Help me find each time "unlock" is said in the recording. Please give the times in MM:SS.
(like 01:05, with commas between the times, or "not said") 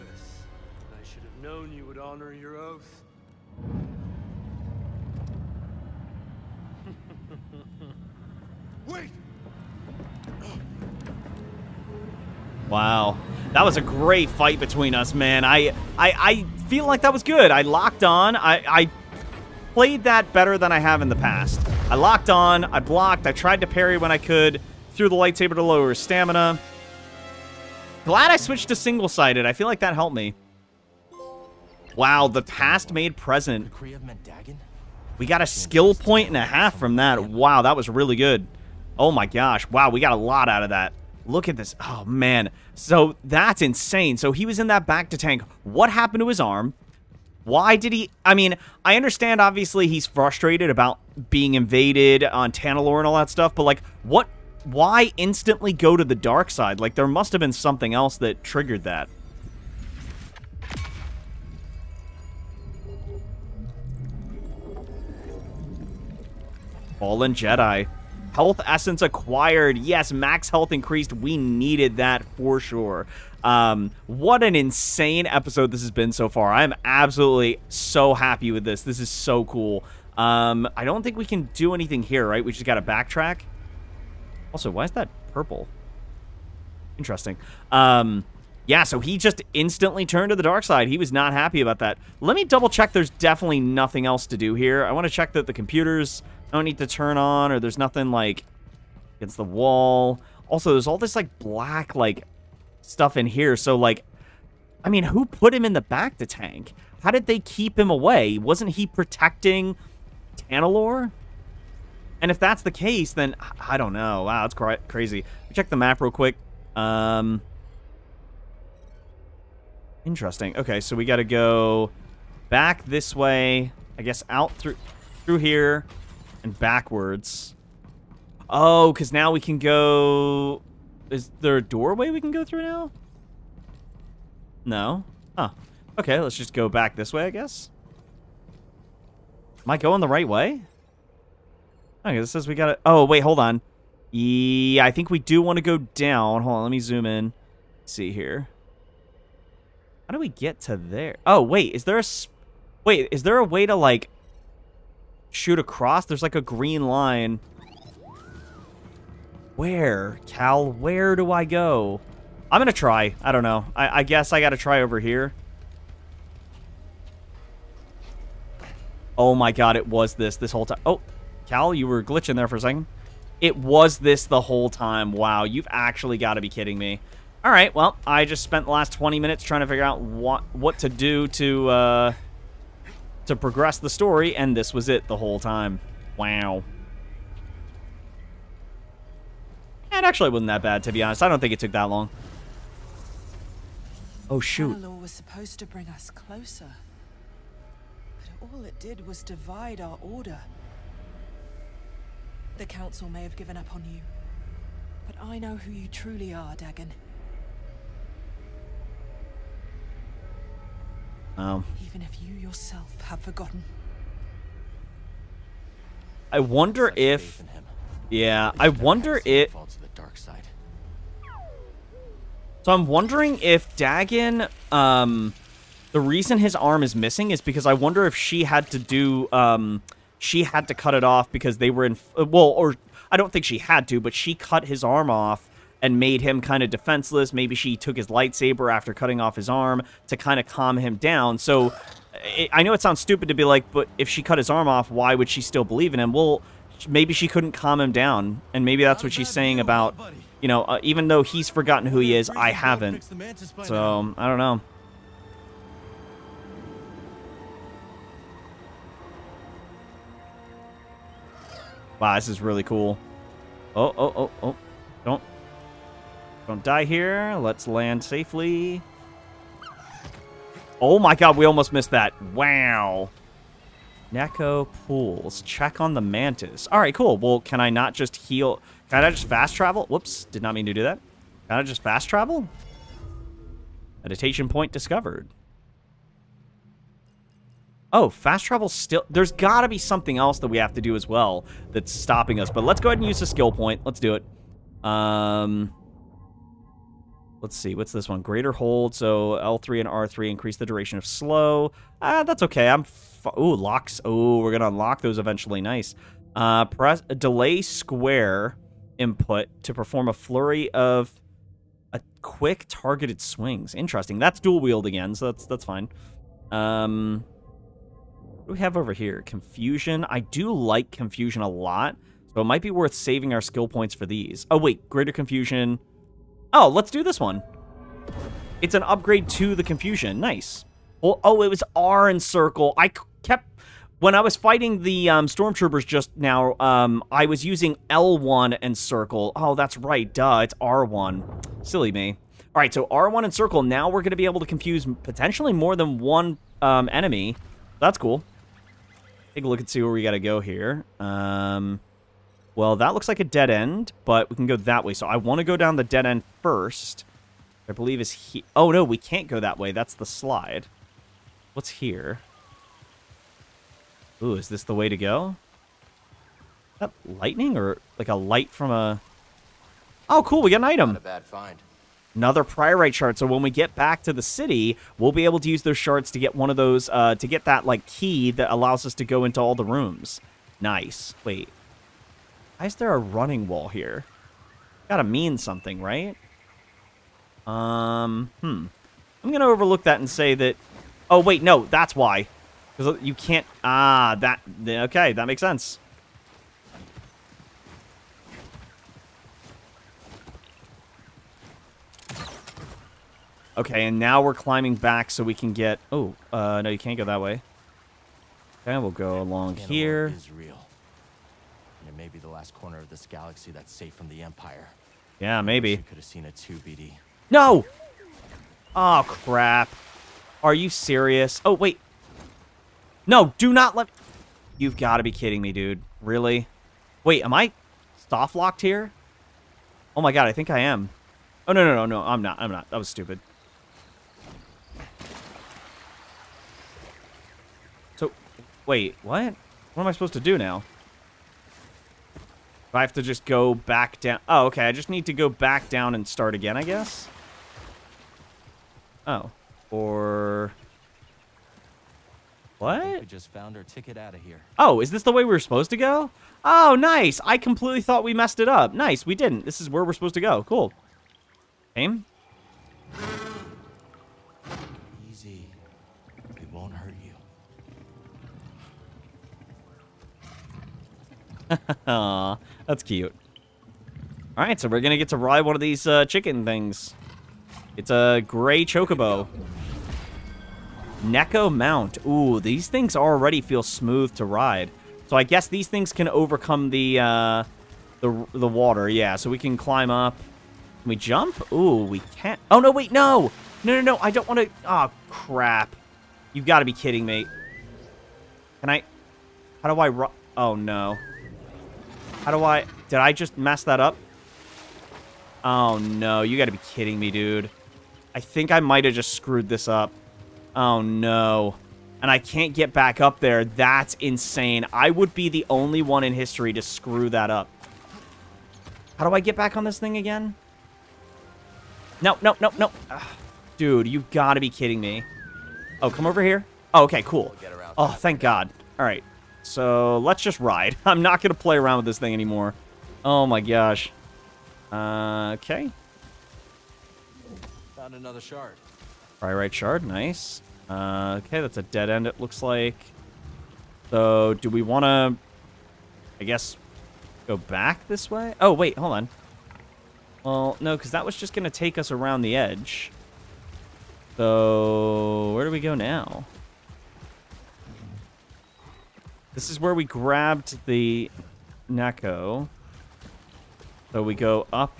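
05:04.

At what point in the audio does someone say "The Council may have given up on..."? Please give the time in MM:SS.
03:22.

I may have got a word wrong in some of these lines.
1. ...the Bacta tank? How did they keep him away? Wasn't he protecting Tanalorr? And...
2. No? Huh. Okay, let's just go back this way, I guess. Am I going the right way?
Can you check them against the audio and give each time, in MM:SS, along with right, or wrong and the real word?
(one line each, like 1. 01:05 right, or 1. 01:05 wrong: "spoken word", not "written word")
1. 01:45 right
2. 02:14 right.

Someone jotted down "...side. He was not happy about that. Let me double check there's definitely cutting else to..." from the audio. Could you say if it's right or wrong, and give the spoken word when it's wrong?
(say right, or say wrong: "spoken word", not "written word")
wrong: "nothing", not "cutting".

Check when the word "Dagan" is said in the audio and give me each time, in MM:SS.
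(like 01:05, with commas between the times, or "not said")
03:26, 03:43.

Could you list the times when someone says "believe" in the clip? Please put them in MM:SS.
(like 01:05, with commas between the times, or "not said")
04:05, 05:57.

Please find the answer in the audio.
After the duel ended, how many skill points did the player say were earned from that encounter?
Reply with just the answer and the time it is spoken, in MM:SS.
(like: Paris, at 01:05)
1.5, at 00:35.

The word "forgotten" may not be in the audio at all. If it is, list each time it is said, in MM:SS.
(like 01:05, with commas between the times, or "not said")
03:33, 04:11.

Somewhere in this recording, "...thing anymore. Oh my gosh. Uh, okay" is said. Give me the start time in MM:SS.
08:51.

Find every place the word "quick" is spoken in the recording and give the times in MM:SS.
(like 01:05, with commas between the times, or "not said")
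01:56, 05:12.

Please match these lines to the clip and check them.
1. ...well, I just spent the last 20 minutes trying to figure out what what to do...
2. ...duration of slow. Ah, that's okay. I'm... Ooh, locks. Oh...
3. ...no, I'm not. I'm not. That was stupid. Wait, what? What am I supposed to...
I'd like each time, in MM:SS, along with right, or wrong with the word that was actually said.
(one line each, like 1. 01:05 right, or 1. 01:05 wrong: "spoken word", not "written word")
1. 02:57 right
2. 05:00 right
3. 07:11 right.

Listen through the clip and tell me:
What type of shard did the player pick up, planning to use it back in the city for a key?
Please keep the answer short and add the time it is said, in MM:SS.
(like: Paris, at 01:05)
Priorite shard, at 06:12.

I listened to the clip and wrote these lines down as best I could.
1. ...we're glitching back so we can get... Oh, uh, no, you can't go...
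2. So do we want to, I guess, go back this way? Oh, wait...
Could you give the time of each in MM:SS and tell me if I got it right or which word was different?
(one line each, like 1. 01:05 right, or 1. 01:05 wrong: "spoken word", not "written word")
1. 06:44 wrong: "climbing", not "glitching"
2. 09:03 right.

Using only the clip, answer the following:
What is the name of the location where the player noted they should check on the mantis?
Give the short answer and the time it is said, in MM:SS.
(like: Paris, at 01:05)
Nekko pools, at 04:34.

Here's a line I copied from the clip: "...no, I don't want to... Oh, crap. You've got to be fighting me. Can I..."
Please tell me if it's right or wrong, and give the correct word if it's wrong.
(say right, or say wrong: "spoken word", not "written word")
wrong: "kidding", not "fighting".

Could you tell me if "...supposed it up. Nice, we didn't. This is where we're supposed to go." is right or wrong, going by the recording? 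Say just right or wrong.
wrong.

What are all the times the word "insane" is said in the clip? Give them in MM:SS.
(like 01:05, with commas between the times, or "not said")
00:43, 01:14, 08:33.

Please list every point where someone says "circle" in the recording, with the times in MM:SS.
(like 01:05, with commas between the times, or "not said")
05:32, 05:38, 05:43.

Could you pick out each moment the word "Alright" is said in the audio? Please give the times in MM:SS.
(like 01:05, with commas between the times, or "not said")
07:54.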